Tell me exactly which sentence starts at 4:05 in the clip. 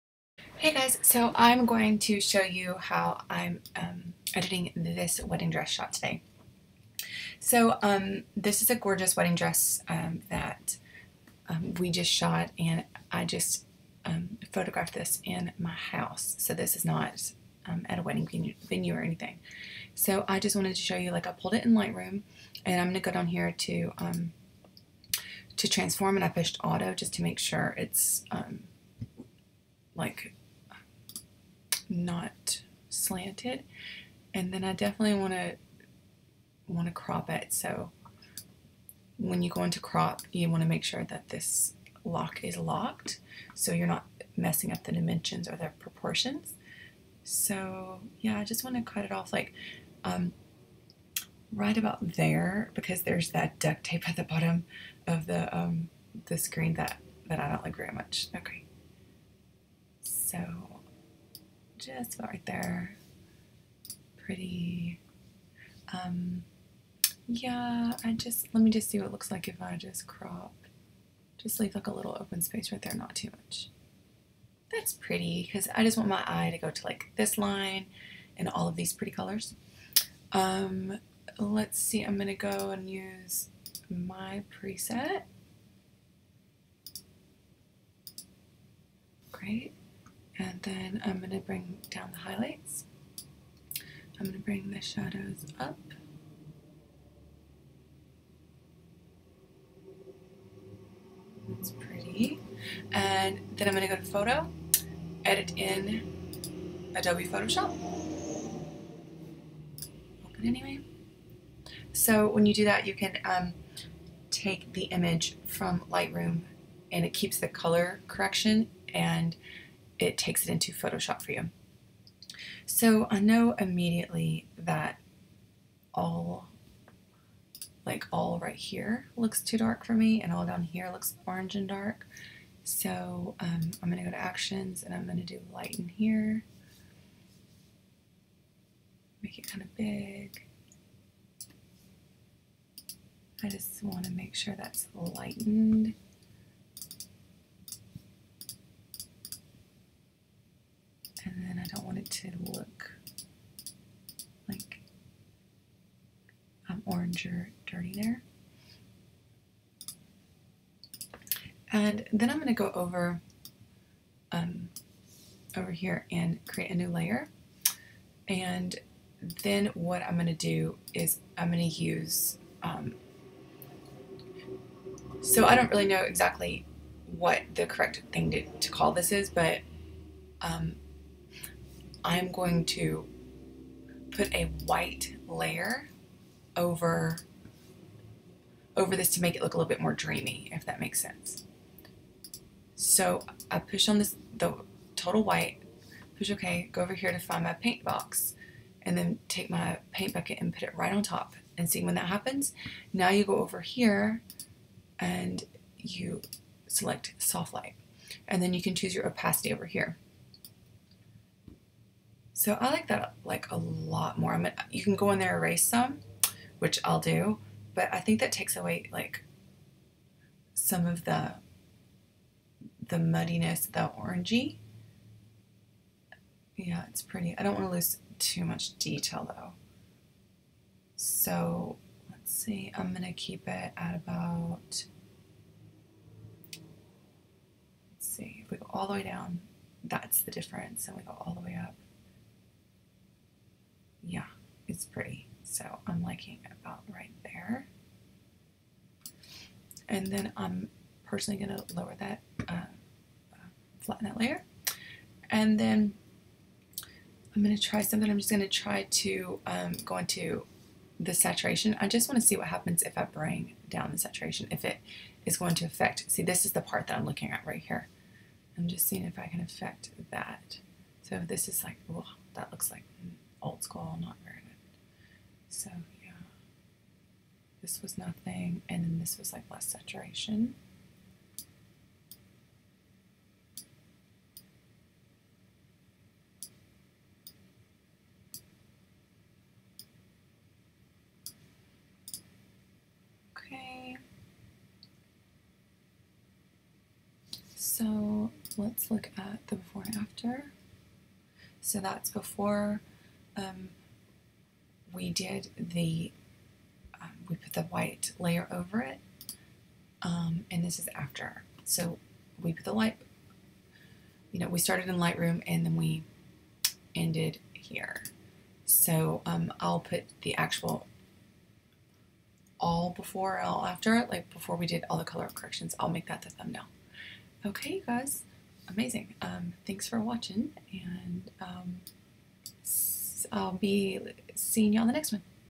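So I'm liking about right there.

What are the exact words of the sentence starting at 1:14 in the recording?
That's pretty, because I just want my eye to go to like this line and all of these pretty colors.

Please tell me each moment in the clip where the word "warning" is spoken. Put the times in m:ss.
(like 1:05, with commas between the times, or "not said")
not said.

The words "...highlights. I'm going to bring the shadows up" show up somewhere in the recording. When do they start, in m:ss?
1:32.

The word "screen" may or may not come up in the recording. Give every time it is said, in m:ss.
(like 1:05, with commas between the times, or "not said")
0:56.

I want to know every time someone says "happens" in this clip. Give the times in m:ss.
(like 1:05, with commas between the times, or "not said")
3:22, 4:22.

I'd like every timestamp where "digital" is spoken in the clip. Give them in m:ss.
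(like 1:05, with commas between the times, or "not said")
not said.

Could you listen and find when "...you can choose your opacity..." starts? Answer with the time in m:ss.
3:28.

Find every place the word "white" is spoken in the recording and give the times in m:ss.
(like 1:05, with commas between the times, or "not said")
3:04, 3:15, 5:07.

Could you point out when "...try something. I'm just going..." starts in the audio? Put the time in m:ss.
4:17.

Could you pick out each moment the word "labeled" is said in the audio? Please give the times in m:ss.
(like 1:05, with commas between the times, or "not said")
not said.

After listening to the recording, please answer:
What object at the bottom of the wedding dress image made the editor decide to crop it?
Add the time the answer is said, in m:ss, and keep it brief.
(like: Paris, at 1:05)
Duct tape, at 0:53.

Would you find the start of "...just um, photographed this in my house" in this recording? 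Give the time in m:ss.
0:13.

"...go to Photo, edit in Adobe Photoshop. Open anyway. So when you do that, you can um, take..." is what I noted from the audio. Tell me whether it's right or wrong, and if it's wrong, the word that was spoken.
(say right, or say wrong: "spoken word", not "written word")
right.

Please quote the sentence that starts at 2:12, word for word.
So um, I'm going to go to actions and I'm going to do lighten here.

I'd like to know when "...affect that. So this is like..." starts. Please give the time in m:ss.
4:29.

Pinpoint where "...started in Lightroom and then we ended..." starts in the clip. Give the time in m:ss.
5:14.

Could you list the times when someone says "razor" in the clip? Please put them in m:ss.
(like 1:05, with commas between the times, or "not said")
not said.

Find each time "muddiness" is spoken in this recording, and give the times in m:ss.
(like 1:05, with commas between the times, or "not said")
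3:42.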